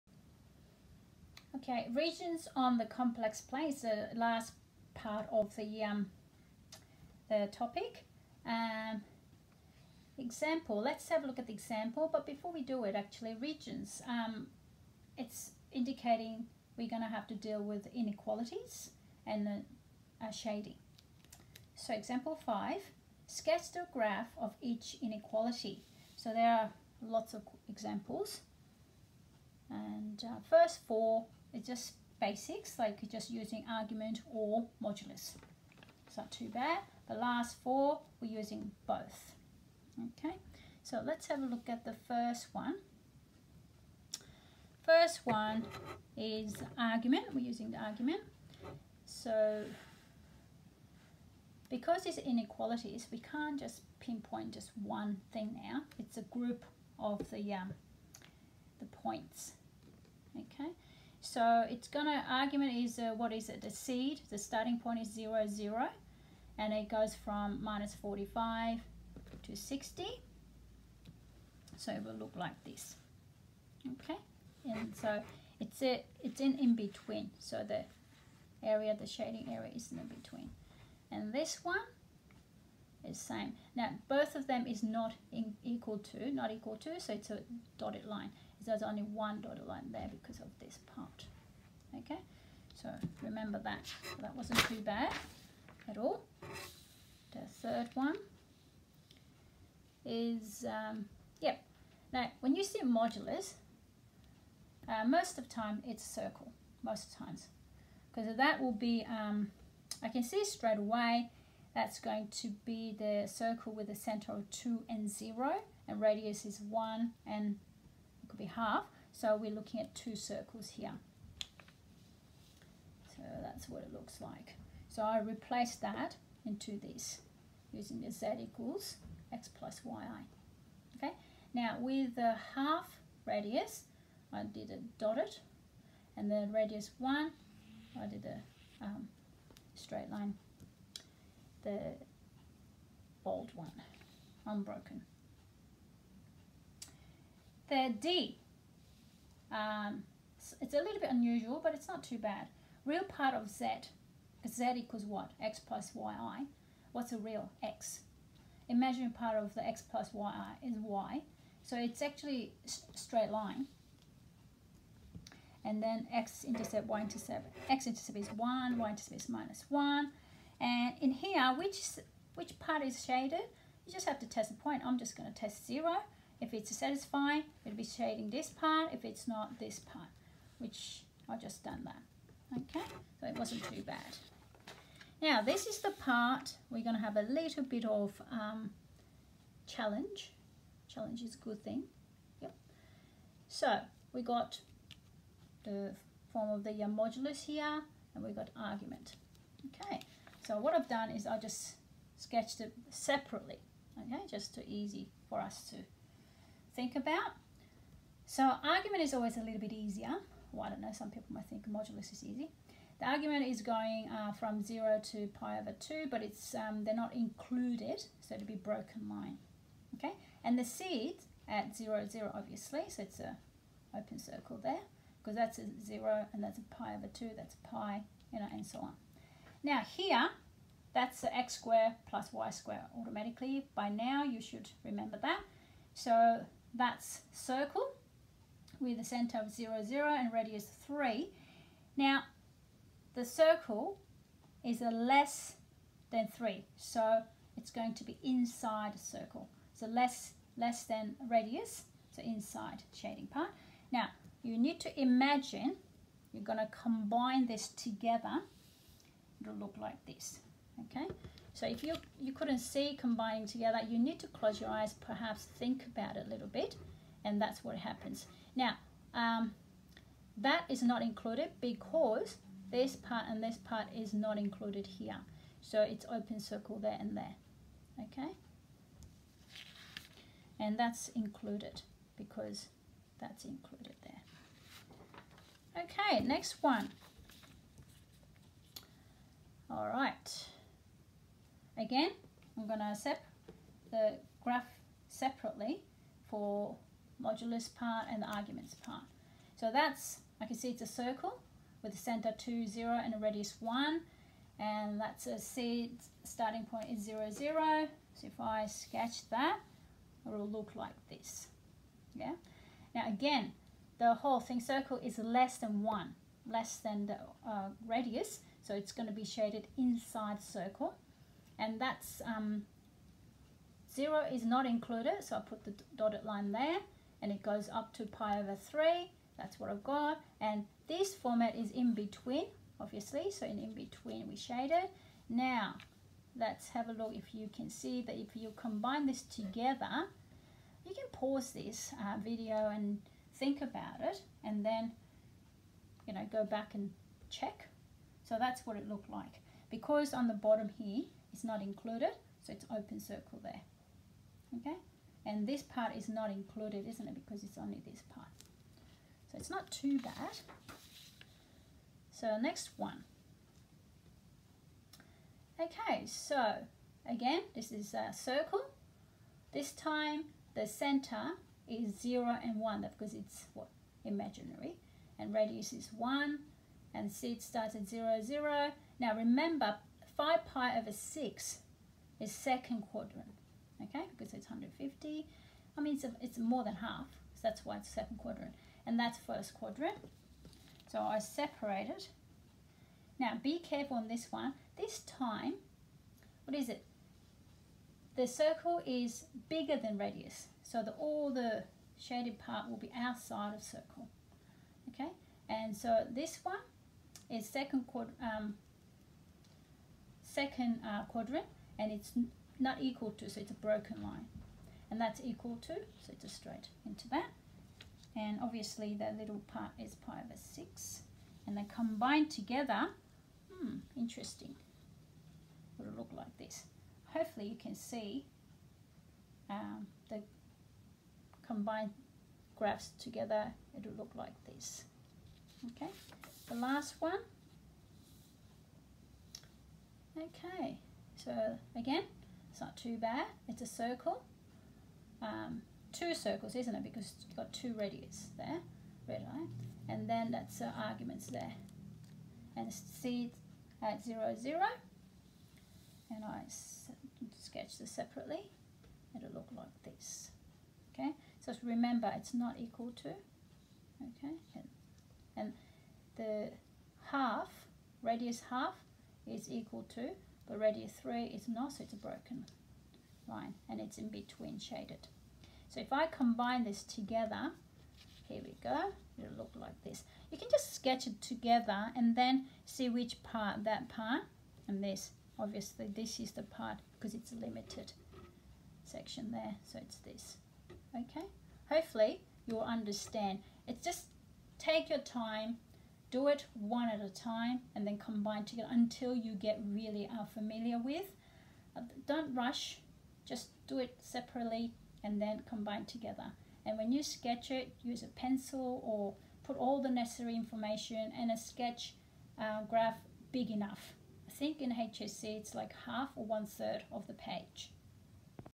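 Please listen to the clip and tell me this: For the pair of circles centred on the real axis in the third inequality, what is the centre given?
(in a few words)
2 and 0.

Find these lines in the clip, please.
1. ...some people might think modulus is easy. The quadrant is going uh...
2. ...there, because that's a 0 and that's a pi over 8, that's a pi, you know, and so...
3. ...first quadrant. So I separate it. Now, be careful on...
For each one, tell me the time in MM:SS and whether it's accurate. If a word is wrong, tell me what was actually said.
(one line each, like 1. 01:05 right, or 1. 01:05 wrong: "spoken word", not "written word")
1. 03:30 wrong: "argument", not "quadrant"
2. 03:44 wrong: "2", not "8"
3. 06:29 right.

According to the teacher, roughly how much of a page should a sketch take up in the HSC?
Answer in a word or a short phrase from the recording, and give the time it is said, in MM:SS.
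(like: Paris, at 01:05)
half or one third, at 08:35.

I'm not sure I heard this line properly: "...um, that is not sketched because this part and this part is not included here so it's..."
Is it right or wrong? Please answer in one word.
wrong.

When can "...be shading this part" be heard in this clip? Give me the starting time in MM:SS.
02:57.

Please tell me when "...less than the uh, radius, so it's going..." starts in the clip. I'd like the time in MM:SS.
05:16.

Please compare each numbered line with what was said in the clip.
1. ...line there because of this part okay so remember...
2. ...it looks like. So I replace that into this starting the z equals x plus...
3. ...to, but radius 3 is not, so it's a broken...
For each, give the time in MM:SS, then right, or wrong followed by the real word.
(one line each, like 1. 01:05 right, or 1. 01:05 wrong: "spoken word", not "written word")
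1. 01:29 right
2. 02:03 wrong: "using", not "starting"
3. 07:49 right.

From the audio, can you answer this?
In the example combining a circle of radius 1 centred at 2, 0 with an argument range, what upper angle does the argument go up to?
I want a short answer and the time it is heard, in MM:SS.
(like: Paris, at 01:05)
pi over 3, at 05:28.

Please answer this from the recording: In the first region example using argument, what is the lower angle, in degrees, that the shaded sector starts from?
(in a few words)
-45.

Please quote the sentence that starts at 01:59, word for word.
So we're looking at two circles here.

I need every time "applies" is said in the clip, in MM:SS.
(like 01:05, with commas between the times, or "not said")
not said.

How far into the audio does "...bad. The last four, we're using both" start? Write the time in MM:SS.
00:36.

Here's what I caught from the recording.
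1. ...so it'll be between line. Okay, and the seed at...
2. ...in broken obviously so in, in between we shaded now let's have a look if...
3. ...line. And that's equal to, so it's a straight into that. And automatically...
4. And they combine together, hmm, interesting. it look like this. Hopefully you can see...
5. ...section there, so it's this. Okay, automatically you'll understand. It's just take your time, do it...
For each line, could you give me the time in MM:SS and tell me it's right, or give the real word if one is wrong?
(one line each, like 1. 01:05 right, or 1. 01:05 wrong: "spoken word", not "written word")
1. 03:38 wrong: "broken", not "between"
2. 05:31 wrong: "between", not "broken"
3. 06:54 wrong: "obviously", not "automatically"
4. 07:01 right
5. 08:08 wrong: "hopefully", not "automatically".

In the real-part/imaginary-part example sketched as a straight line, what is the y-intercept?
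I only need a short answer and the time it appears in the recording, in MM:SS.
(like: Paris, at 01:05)
-1, at 02:49.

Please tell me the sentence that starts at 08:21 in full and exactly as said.
Uh, don't rush, just do it separately and then combine together.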